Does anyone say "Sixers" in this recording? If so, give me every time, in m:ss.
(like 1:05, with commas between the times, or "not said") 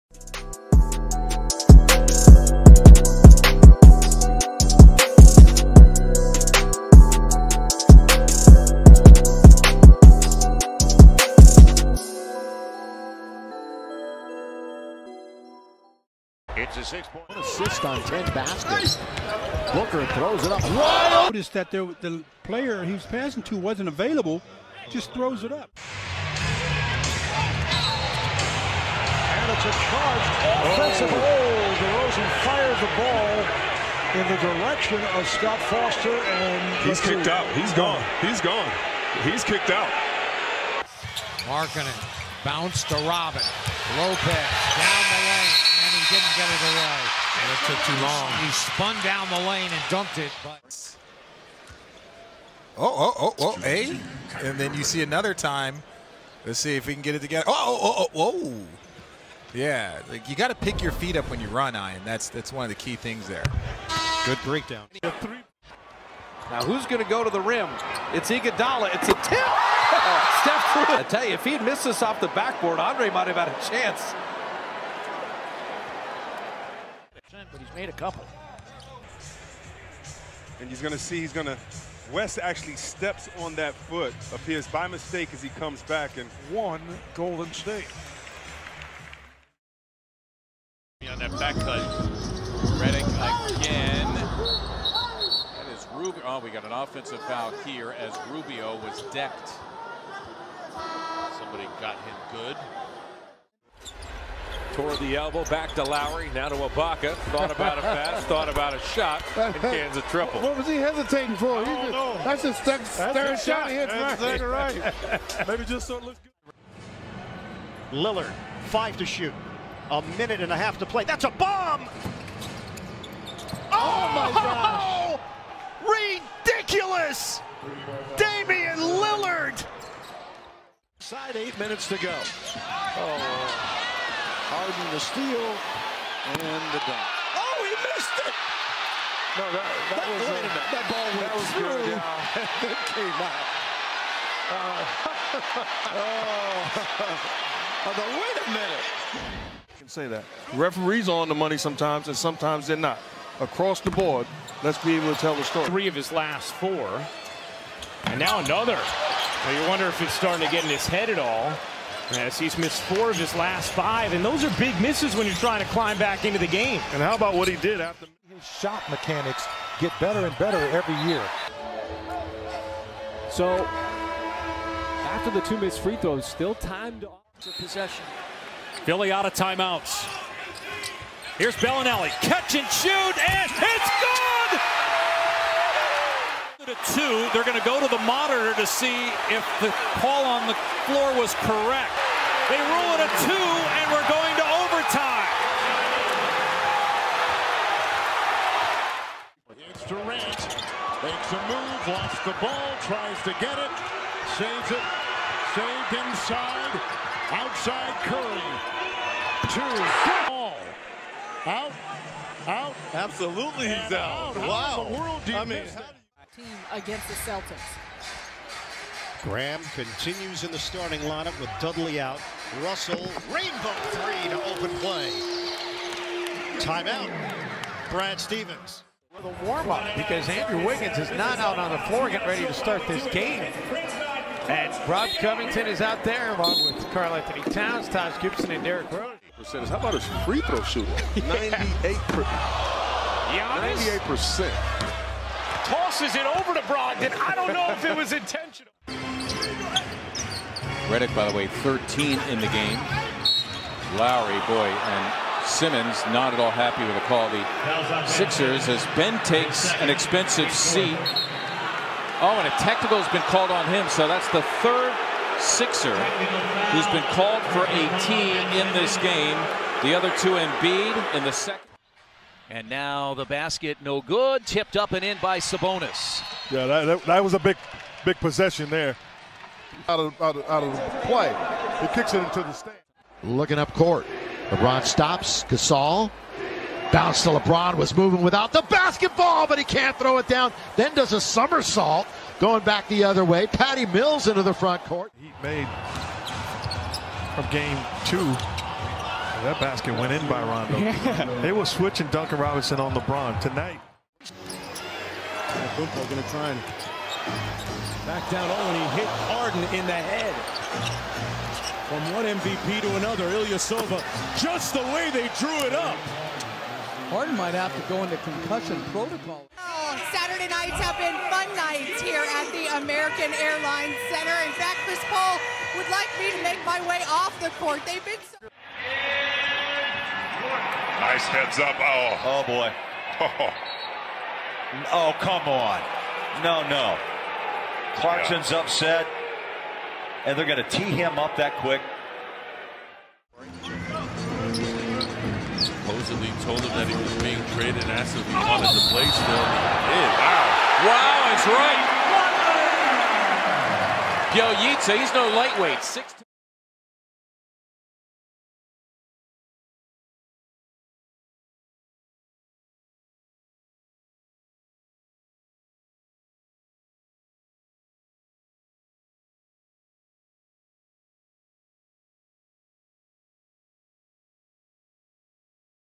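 4:18, 4:25.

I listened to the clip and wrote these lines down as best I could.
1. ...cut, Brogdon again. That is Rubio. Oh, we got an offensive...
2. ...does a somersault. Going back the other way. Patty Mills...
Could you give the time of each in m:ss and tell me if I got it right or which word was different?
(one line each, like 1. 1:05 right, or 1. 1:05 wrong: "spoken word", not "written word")
1. 1:31 wrong: "Redding", not "Brogdon"
2. 4:50 right.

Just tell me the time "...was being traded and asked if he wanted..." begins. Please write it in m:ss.
5:46.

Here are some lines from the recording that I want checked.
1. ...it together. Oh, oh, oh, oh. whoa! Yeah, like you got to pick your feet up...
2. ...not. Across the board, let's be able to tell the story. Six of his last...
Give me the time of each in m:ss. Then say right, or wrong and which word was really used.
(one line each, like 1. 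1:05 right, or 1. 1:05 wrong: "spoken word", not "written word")
1. 0:57 right
2. 2:32 wrong: "Three", not "Six".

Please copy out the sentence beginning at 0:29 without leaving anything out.
And it's a charged offensive oh.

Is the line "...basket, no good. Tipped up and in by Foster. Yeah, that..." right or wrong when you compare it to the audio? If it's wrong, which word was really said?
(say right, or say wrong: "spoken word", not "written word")
wrong: "Sabonis", not "Foster".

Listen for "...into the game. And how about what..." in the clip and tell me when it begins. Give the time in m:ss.
2:46.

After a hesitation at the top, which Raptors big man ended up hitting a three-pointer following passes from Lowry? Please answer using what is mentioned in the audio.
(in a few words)
Ibaka.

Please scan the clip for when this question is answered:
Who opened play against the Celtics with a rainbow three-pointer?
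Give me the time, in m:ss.
3:42.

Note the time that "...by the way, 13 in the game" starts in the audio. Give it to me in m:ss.
4:11.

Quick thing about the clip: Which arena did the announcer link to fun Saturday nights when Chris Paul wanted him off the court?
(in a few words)
American Airlines Center.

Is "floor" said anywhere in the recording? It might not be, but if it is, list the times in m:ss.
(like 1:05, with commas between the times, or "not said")
3:10, 3:51.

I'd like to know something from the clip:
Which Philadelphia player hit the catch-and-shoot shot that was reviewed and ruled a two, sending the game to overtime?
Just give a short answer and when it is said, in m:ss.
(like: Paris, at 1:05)
Belinelli, at 3:01.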